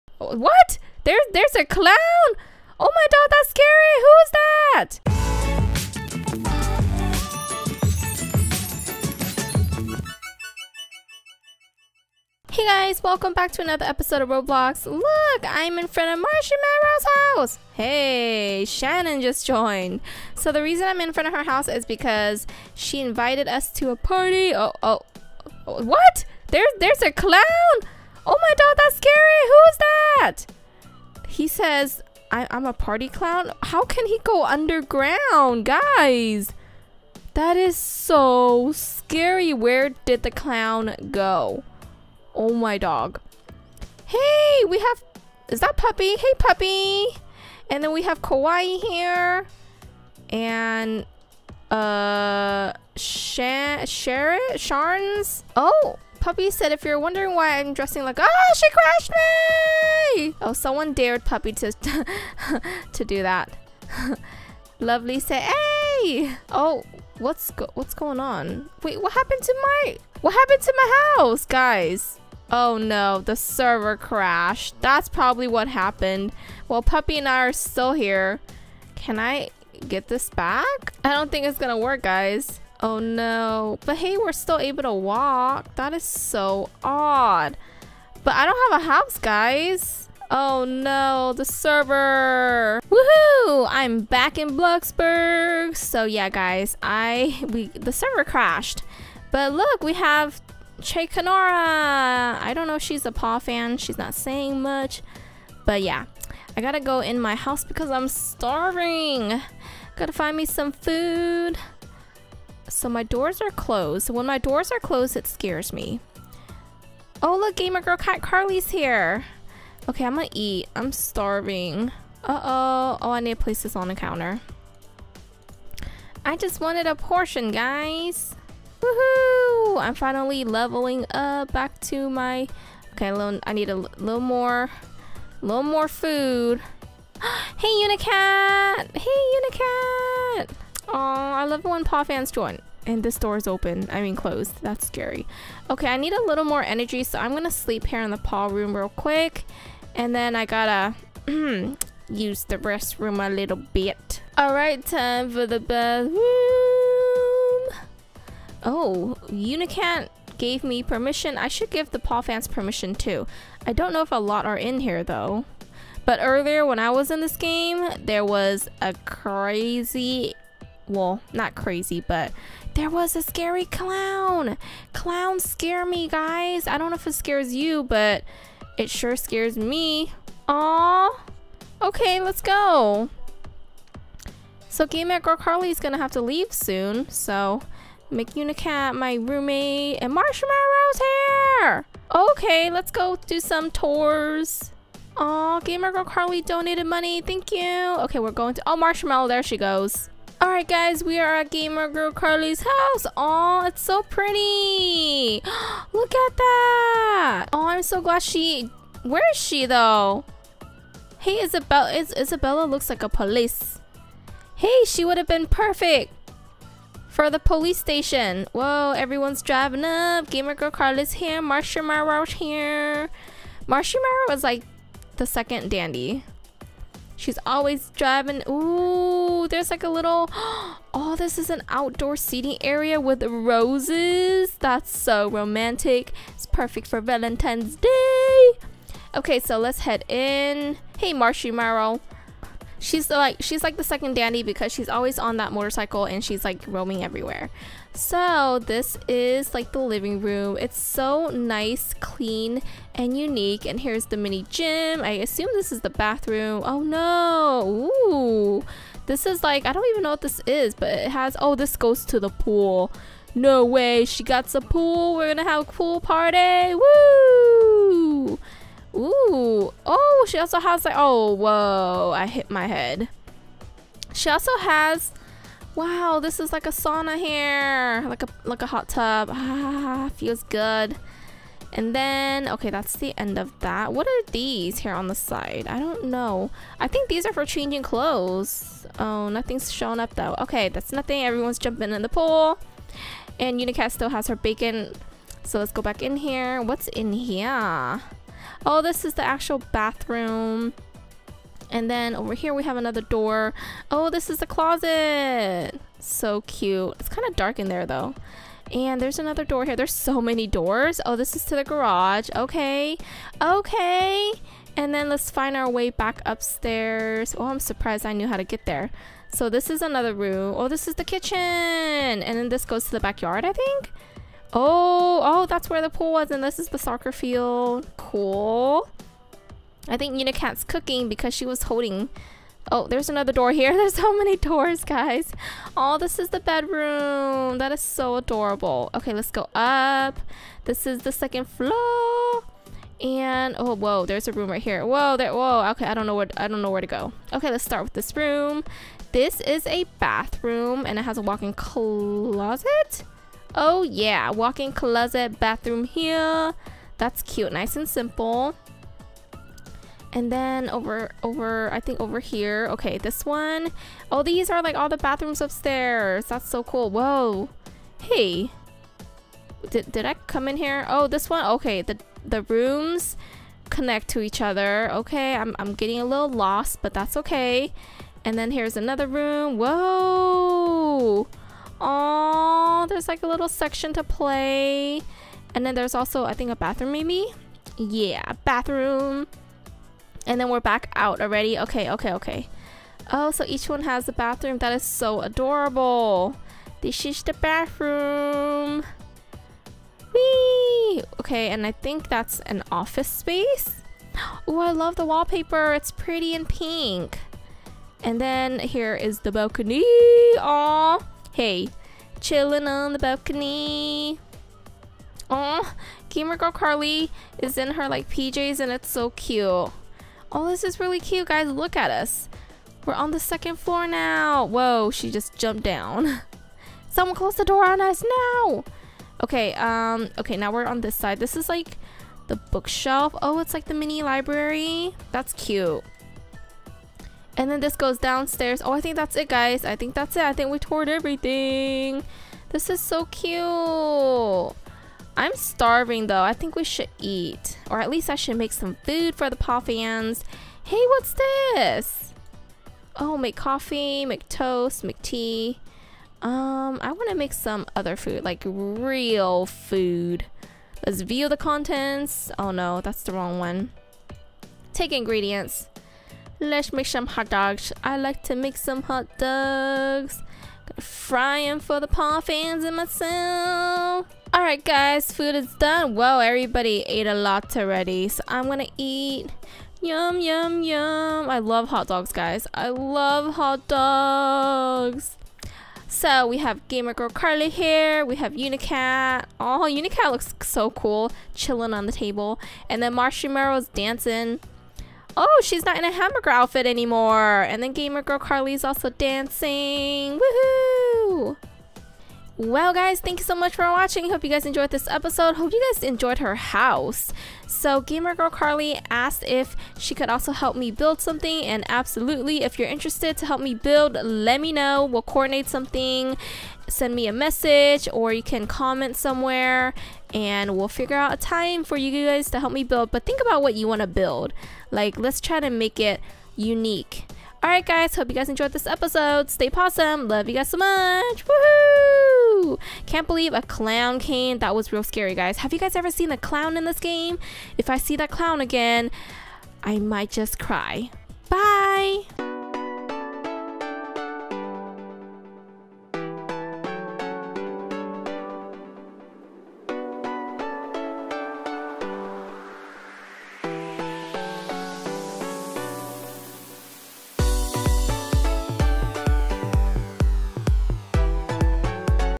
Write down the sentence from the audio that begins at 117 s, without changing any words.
Oh, look, Gamer Girl Cat Carly's here.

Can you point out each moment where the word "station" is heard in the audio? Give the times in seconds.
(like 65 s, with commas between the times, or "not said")
217 s.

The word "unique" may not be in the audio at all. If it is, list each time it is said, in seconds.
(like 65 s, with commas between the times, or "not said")
253 s, 526 s.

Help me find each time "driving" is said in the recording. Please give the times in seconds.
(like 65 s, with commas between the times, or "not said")
219 s, 227 s.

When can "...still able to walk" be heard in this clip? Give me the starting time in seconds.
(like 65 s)
84 s.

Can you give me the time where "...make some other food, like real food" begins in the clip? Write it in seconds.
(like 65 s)
457 s.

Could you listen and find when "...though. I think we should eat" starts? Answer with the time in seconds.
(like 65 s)
446 s.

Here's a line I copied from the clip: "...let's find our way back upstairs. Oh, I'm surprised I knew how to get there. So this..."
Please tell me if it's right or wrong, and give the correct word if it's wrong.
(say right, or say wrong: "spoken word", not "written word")
right.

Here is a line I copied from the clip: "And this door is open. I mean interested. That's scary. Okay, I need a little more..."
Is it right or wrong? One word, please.
wrong.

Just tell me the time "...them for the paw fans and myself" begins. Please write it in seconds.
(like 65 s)
471 s.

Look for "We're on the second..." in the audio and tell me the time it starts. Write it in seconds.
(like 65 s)
422 s.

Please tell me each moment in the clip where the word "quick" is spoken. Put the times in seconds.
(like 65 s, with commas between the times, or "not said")
148 s.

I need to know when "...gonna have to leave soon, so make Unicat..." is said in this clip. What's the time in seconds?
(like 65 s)
185 s.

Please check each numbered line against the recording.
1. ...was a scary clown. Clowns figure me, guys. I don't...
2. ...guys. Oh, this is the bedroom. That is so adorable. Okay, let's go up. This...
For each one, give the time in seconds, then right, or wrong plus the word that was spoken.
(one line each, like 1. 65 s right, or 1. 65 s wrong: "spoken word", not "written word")
1. 172 s wrong: "scare", not "figure"
2. 334 s right.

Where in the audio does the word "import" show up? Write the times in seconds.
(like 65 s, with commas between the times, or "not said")
not said.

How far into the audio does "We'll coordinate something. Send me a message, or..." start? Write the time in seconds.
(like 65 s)
514 s.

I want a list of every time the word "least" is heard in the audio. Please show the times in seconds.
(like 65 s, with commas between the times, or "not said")
447 s.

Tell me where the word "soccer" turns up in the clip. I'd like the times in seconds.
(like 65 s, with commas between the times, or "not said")
326 s.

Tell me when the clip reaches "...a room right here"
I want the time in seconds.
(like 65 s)
344 s.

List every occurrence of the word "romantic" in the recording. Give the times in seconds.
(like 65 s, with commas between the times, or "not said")
235 s.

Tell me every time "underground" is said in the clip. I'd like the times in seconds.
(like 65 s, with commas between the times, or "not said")
34 s.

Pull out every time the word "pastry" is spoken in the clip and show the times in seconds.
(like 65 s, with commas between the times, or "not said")
not said.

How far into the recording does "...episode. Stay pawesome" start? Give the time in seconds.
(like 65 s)
528 s.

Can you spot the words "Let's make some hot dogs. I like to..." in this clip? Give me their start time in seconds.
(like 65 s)
466 s.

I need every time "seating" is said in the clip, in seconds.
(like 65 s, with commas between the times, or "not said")
232 s.